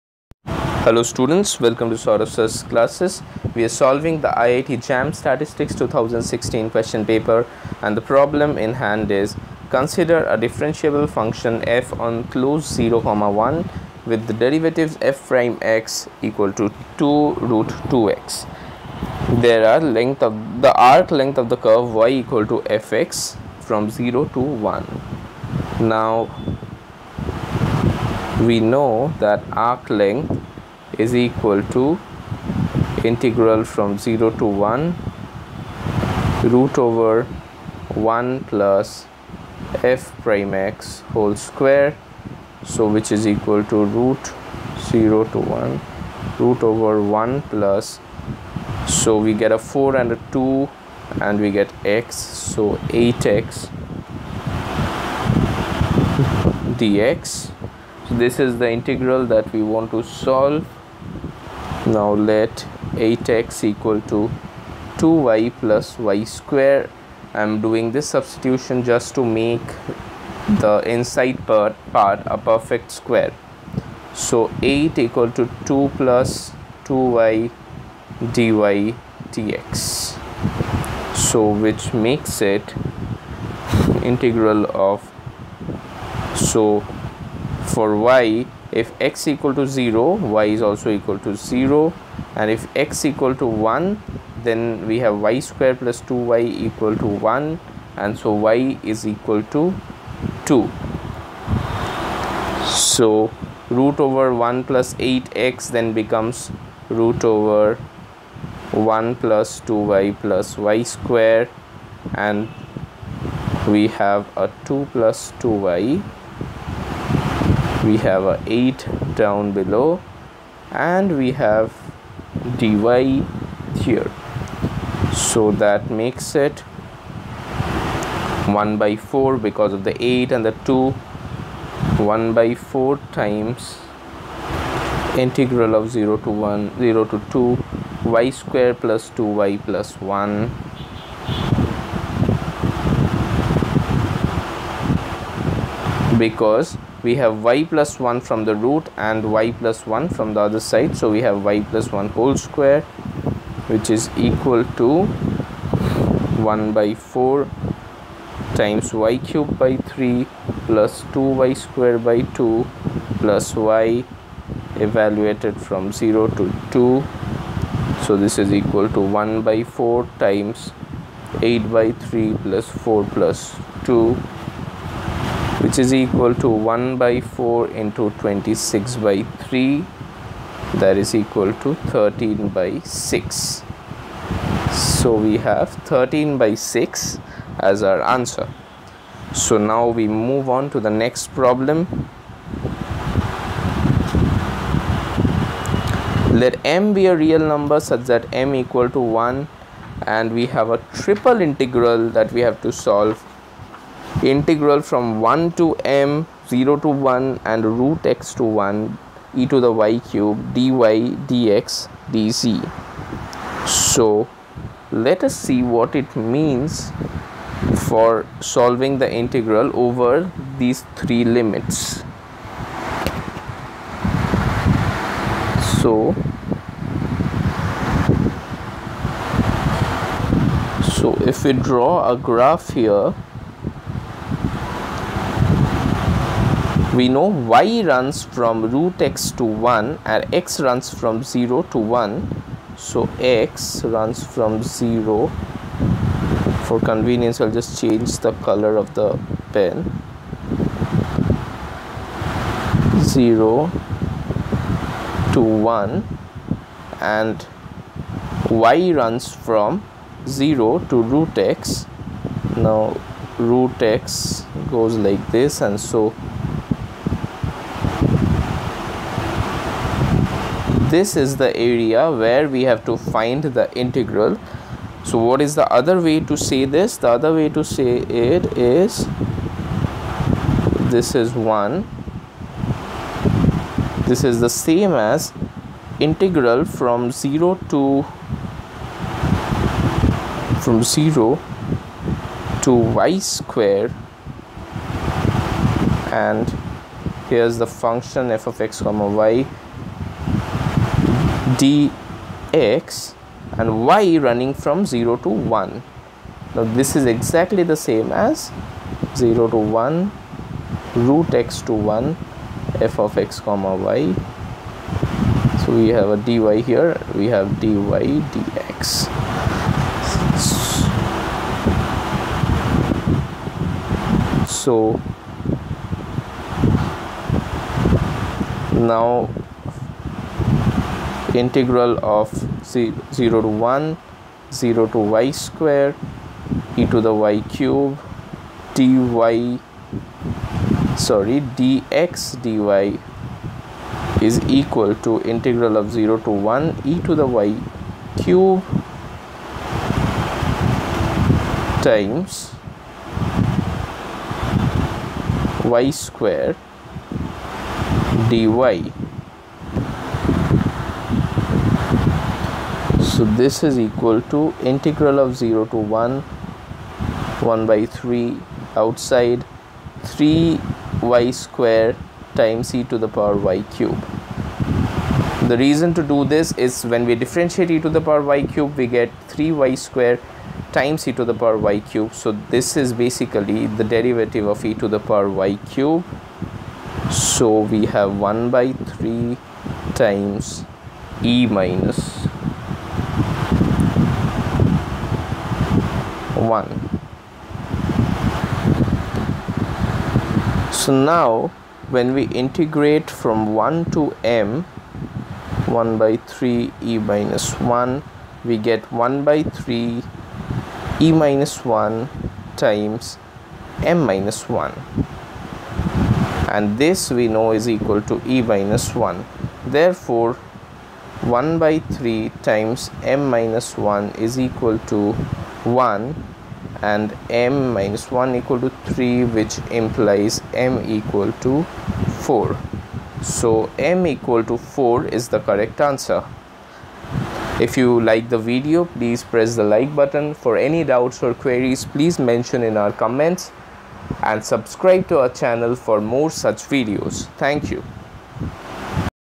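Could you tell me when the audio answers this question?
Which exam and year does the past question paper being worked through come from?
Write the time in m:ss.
0:04.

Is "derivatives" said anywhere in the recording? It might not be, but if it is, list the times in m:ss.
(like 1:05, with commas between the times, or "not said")
0:14, 6:23.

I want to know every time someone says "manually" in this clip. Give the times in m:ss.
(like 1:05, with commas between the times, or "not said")
not said.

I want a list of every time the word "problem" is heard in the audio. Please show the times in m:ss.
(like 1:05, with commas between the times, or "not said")
0:08, 3:11.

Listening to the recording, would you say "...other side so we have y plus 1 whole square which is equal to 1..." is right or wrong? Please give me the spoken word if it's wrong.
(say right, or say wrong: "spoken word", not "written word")
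right.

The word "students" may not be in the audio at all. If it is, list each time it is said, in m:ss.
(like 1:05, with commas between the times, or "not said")
0:01.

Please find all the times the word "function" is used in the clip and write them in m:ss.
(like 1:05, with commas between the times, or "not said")
0:11, 4:57.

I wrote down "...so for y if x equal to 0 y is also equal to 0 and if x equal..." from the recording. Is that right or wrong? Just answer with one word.
right.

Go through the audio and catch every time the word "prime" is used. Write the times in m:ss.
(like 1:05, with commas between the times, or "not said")
0:15, 0:40.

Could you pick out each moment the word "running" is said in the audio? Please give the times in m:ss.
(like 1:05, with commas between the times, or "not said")
5:04.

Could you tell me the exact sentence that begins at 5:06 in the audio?
Now this is exactly the same as 0 to 1 root x to 1 f of x comma y.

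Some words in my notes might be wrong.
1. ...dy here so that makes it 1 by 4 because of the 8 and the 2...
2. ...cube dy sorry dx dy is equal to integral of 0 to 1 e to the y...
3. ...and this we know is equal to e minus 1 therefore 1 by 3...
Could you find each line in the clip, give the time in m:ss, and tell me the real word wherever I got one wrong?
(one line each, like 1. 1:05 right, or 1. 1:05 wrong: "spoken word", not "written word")
1. 2:02 right
2. 5:37 right
3. 6:56 right.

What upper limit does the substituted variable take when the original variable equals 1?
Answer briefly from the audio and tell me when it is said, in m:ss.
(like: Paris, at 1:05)
2, at 1:38.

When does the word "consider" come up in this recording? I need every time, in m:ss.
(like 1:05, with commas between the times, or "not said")
0:09.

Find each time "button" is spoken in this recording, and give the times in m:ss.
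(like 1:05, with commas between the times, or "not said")
7:19.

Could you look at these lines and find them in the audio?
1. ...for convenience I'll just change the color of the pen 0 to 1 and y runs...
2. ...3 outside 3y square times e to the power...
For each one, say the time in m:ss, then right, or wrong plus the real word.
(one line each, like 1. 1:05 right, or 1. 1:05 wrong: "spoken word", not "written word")
1. 4:06 right
2. 6:07 right.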